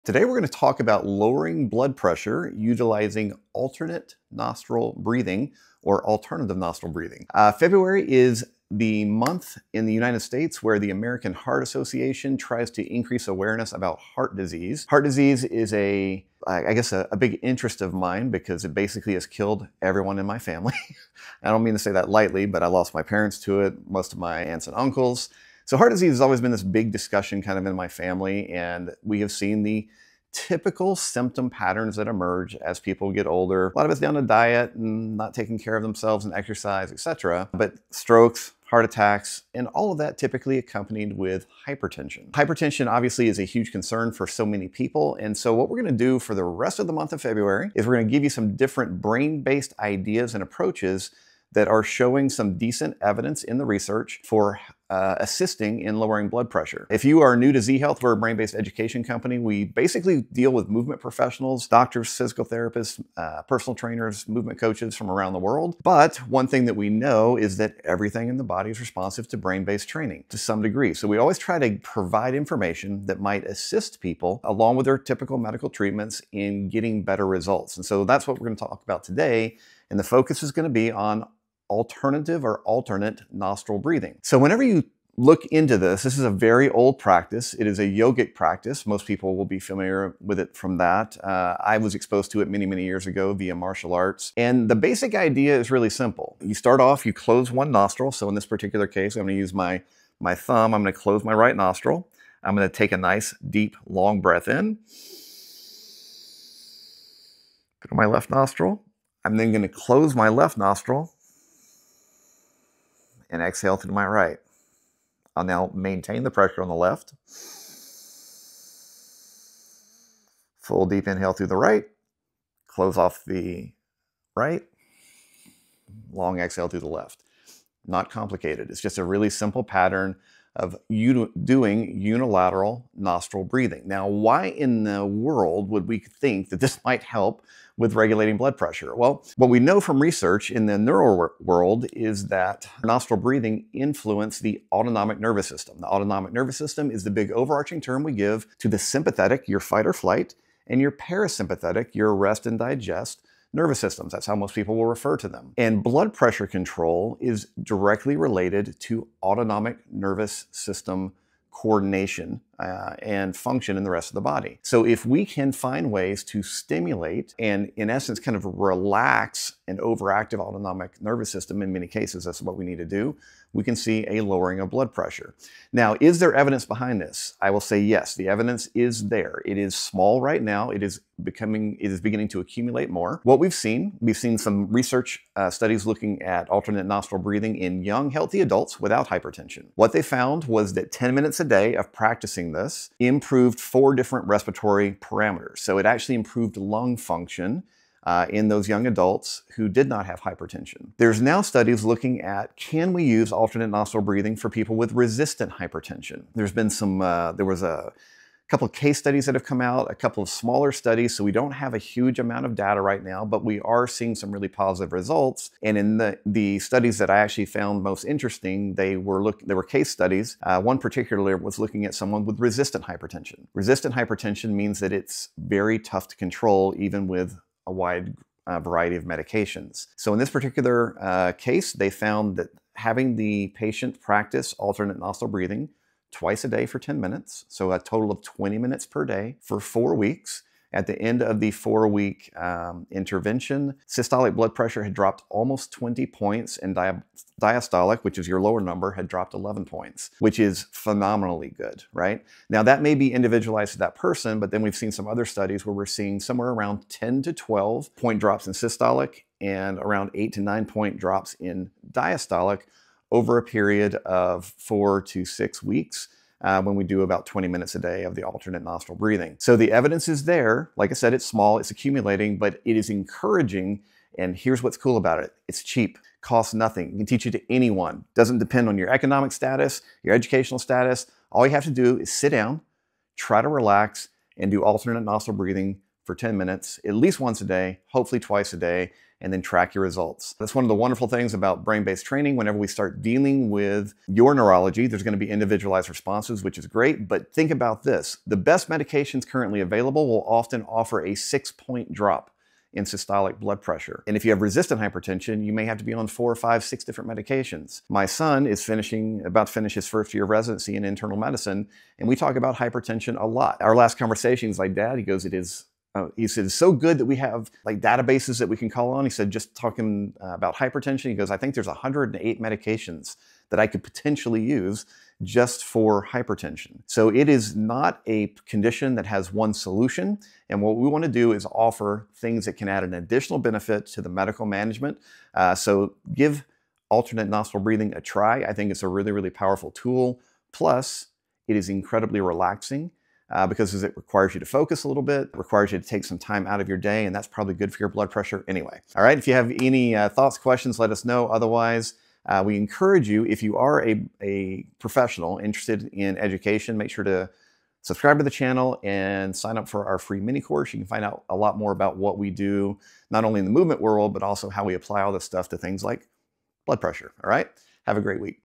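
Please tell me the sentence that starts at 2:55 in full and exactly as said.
Now, is there evidence behind this?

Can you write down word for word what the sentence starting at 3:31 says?
So we don't have a huge amount of data right now, but we are seeing some really positive results.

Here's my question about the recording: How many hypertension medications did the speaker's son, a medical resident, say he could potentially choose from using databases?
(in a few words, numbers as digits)
108.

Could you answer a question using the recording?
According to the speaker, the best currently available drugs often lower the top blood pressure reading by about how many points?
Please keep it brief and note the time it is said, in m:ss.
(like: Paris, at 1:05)
6, at 5:01.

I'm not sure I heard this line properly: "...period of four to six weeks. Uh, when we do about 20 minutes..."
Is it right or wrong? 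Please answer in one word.
right.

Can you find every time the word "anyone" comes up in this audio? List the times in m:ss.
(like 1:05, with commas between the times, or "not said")
4:37.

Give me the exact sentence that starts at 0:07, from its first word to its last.
Uh, February is the month in the United States where the American Heart Association tries to increase awareness about heart disease.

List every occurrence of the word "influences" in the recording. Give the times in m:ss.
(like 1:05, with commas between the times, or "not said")
2:23.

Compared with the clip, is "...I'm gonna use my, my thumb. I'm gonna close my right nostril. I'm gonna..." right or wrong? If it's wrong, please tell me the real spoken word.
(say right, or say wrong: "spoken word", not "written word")
right.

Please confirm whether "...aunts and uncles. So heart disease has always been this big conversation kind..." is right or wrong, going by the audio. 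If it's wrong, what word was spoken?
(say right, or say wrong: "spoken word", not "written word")
wrong: "discussion", not "conversation".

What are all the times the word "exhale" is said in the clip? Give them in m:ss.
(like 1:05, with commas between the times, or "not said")
1:53, 2:06.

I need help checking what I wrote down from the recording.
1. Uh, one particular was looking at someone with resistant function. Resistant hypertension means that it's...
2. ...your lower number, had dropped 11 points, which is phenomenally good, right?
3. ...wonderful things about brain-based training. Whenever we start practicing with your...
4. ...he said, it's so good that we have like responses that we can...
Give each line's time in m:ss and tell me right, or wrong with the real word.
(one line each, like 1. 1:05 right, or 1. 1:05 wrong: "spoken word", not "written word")
1. 3:40 wrong: "hypertension", not "function"
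2. 4:08 right
3. 4:50 wrong: "dealing", not "practicing"
4. 5:16 wrong: "databases", not "responses".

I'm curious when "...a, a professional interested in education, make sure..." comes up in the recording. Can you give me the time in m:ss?
5:53.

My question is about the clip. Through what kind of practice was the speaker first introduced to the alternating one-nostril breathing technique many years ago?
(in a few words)
Martial arts.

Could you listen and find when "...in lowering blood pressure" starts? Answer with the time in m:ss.
0:55.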